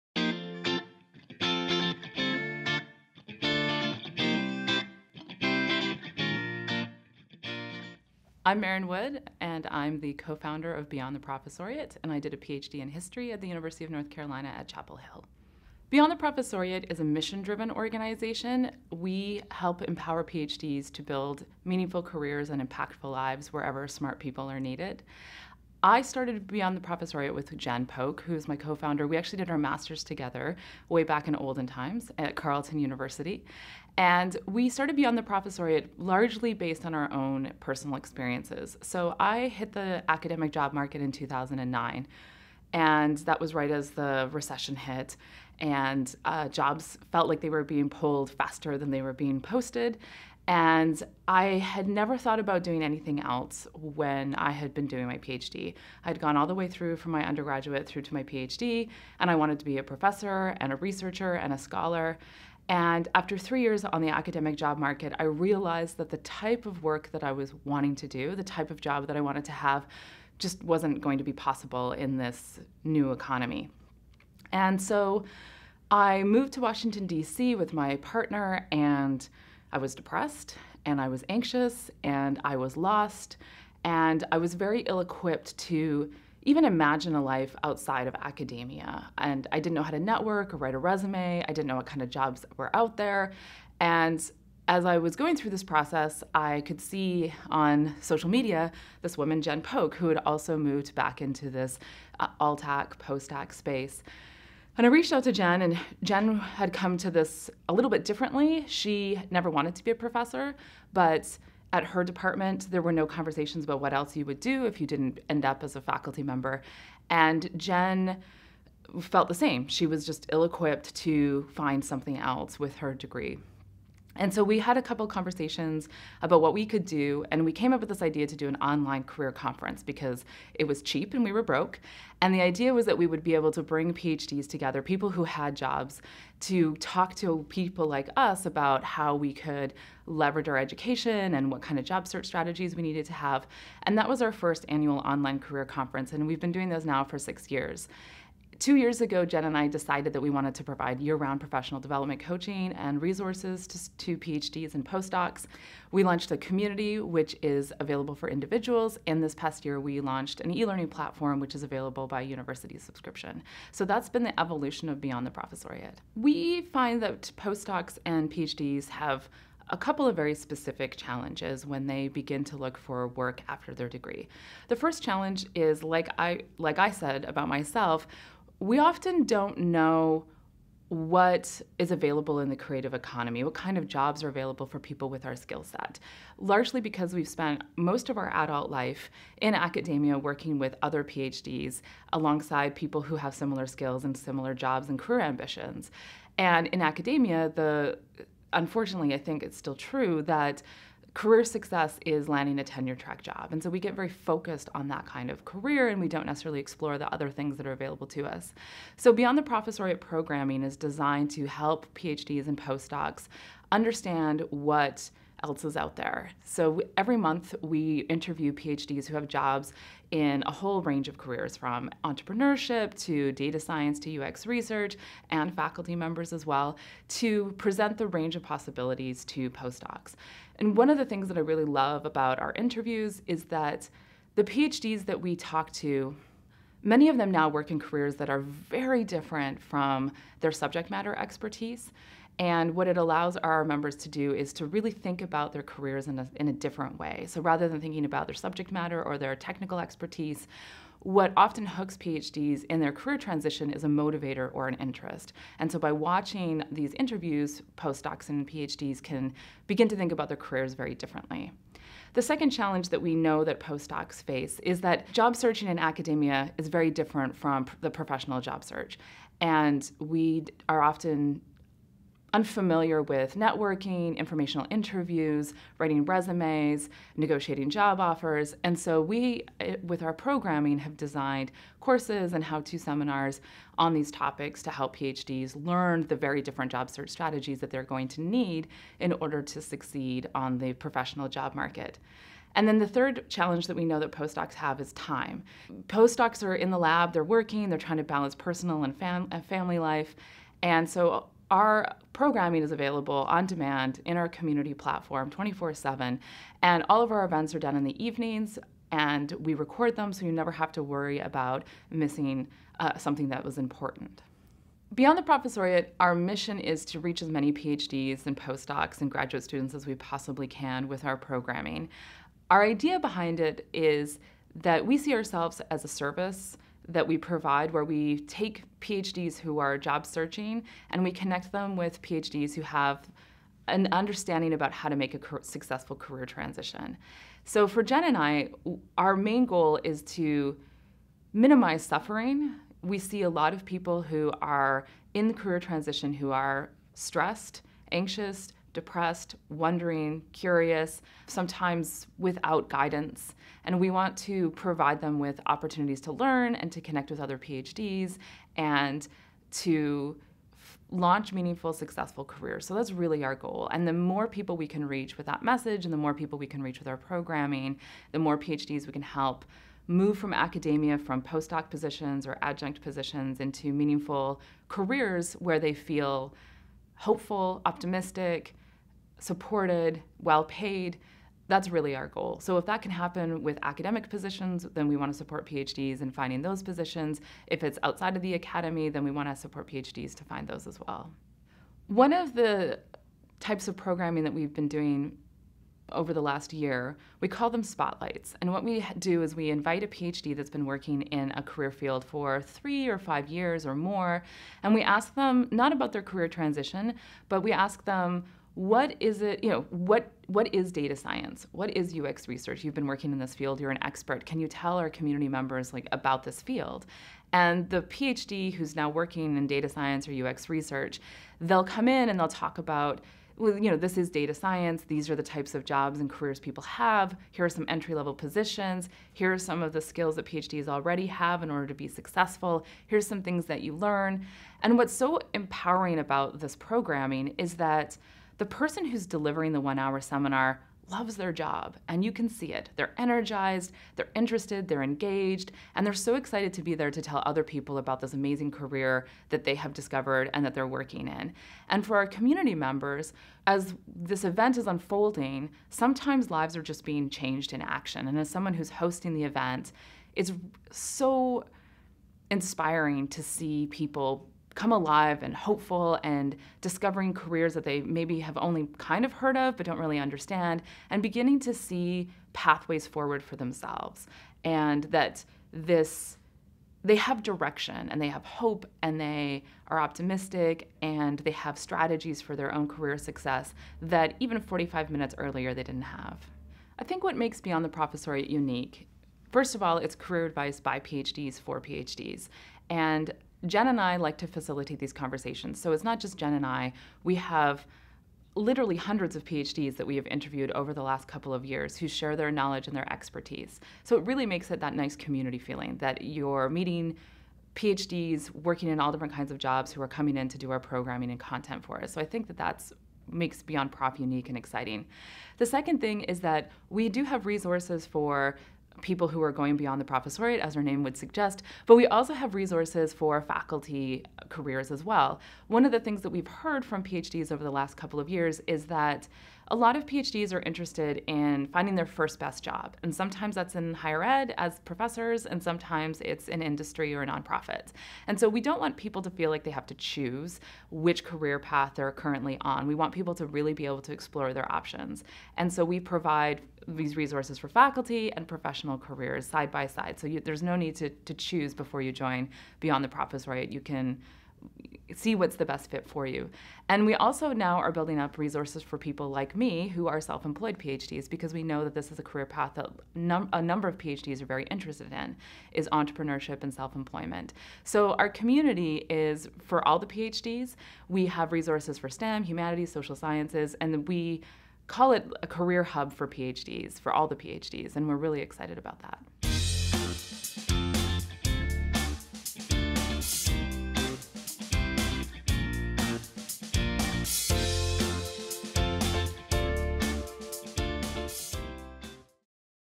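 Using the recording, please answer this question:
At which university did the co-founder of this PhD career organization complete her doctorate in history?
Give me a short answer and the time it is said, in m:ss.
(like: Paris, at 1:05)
University of North Carolina at Chapel Hill, at 0:13.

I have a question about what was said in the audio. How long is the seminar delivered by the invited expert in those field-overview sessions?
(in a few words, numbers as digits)
1 hour.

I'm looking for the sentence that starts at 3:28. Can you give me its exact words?
So Beyond the Professoriate programming is designed to help PhDs and postdocs understand what else is out there.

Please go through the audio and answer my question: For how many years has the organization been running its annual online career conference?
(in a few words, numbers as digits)
6.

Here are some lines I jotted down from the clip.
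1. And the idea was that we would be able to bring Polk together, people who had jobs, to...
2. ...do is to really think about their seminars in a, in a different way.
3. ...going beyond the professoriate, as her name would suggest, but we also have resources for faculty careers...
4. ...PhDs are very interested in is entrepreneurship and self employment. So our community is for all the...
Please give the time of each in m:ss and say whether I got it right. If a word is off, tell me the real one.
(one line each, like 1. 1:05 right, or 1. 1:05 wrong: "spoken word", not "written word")
1. 2:12 wrong: "PhDs", not "Polk"
2. 4:04 wrong: "careers", not "seminars"
3. 8:39 right
4. 9:23 right.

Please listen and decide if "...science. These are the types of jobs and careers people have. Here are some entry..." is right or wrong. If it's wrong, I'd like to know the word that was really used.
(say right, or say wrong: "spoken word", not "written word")
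right.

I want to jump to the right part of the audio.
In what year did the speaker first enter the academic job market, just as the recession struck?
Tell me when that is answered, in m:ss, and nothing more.
0:41.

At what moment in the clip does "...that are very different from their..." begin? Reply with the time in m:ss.
3:58.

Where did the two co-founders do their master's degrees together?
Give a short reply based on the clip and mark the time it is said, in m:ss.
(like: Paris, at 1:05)
Carleton University, at 0:32.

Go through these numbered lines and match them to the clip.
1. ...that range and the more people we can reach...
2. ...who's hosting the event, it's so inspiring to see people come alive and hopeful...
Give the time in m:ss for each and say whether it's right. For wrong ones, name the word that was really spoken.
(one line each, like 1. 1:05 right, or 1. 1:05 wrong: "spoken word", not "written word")
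1. 6:05 wrong: "message", not "range"
2. 7:38 right.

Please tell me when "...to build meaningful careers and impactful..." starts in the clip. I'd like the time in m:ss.
0:20.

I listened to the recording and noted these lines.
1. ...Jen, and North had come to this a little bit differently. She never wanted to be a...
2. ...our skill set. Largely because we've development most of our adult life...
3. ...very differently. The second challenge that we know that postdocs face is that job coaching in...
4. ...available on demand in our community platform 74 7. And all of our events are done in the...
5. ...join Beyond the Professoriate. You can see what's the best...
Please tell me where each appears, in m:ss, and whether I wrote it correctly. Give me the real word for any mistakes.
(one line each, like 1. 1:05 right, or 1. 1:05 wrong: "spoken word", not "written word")
1. 1:45 wrong: "Jen", not "North"
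2. 3:05 wrong: "spent", not "development"
3. 4:20 wrong: "searching", not "coaching"
4. 5:02 wrong: "24", not "74"
5. 9:11 right.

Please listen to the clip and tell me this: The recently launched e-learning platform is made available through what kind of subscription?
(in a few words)
university subscription.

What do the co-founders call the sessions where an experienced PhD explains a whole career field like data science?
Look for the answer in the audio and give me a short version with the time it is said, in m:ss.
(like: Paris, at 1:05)
spotlights, at 6:37.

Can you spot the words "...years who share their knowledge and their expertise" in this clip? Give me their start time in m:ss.
8:21.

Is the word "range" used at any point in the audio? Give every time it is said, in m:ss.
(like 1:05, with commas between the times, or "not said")
3:40, 3:48.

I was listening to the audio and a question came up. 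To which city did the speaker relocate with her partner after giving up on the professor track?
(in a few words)
Washington, D.C.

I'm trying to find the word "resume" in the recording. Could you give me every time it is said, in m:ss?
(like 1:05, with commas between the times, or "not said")
1:30, 4:36.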